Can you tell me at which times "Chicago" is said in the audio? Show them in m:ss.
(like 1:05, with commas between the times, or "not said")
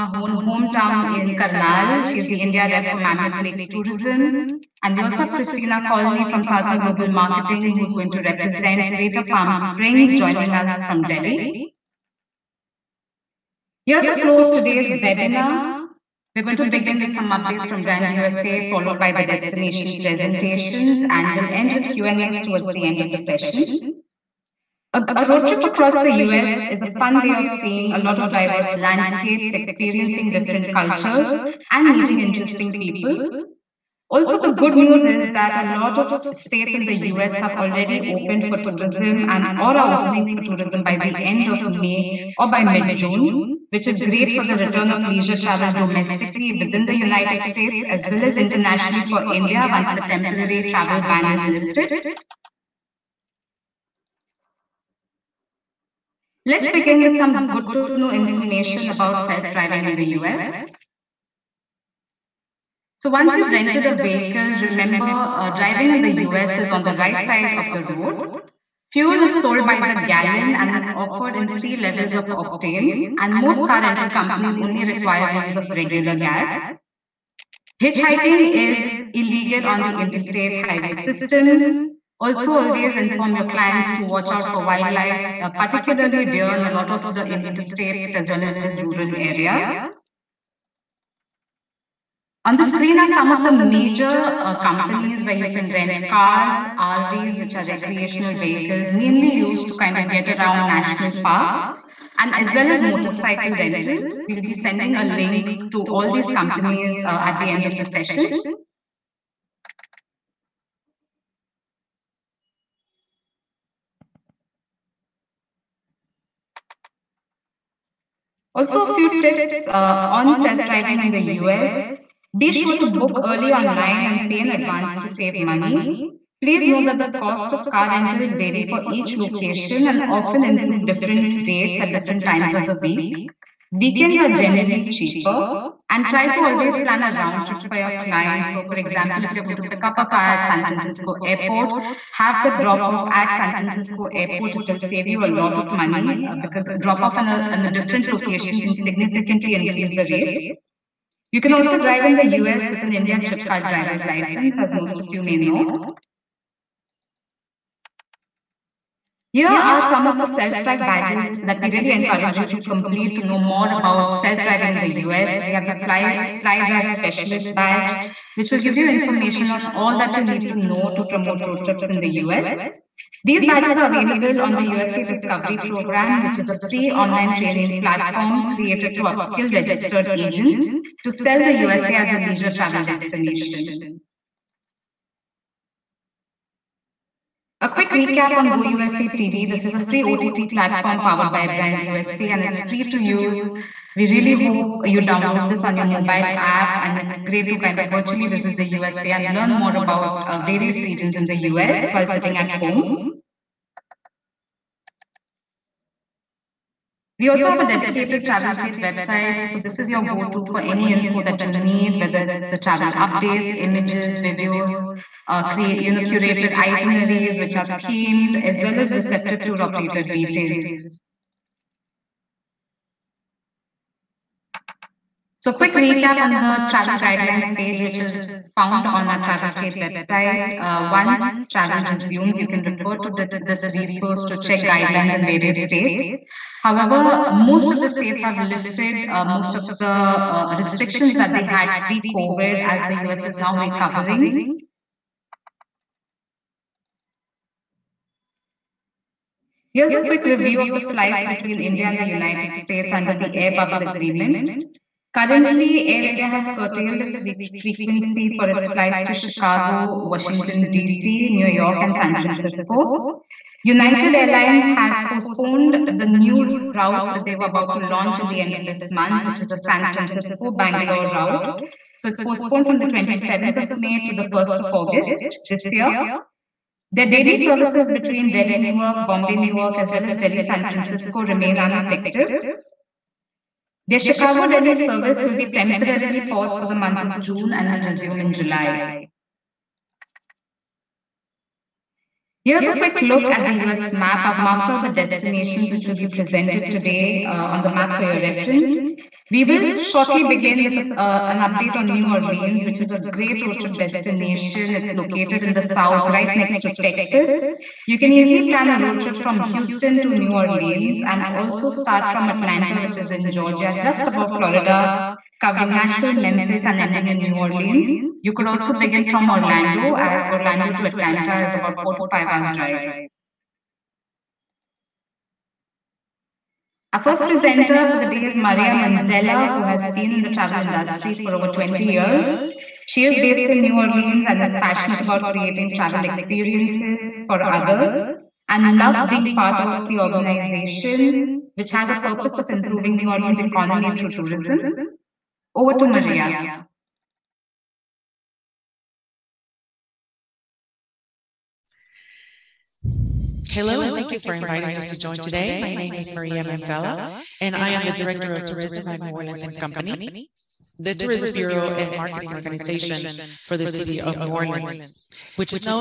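4:19, 4:43.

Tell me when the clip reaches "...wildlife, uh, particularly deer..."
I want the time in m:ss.
1:24.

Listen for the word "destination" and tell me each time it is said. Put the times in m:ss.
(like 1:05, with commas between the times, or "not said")
0:19, 3:02, 4:54, 5:03.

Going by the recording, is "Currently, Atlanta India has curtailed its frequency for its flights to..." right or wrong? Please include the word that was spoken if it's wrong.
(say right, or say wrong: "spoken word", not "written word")
wrong: "Air", not "Atlanta".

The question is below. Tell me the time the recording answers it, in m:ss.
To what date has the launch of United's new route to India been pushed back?
4:34.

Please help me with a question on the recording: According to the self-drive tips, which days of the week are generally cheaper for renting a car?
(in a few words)
Weekends.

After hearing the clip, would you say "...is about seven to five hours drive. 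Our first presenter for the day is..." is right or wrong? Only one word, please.
wrong.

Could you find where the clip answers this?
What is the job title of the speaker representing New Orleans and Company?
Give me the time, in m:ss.
5:57.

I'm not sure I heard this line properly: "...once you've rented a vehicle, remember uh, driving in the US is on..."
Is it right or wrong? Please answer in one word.
right.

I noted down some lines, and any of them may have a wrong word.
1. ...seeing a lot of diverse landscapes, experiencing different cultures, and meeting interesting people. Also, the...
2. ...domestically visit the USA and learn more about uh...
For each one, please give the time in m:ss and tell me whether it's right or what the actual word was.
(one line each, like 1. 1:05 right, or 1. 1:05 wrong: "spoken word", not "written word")
1. 0:27 right
2. 3:17 wrong: "virtually", not "domestically".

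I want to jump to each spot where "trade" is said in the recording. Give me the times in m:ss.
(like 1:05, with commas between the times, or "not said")
3:28, 3:49.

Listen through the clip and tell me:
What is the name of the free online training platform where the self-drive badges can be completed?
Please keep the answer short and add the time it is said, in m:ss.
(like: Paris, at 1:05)
USA Discovery Program, at 2:54.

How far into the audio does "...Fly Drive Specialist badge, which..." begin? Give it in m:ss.
2:46.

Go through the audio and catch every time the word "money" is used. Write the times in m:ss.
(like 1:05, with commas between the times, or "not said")
2:05, 2:25.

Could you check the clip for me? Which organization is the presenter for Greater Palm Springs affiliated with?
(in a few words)
Sartha Global Marketing.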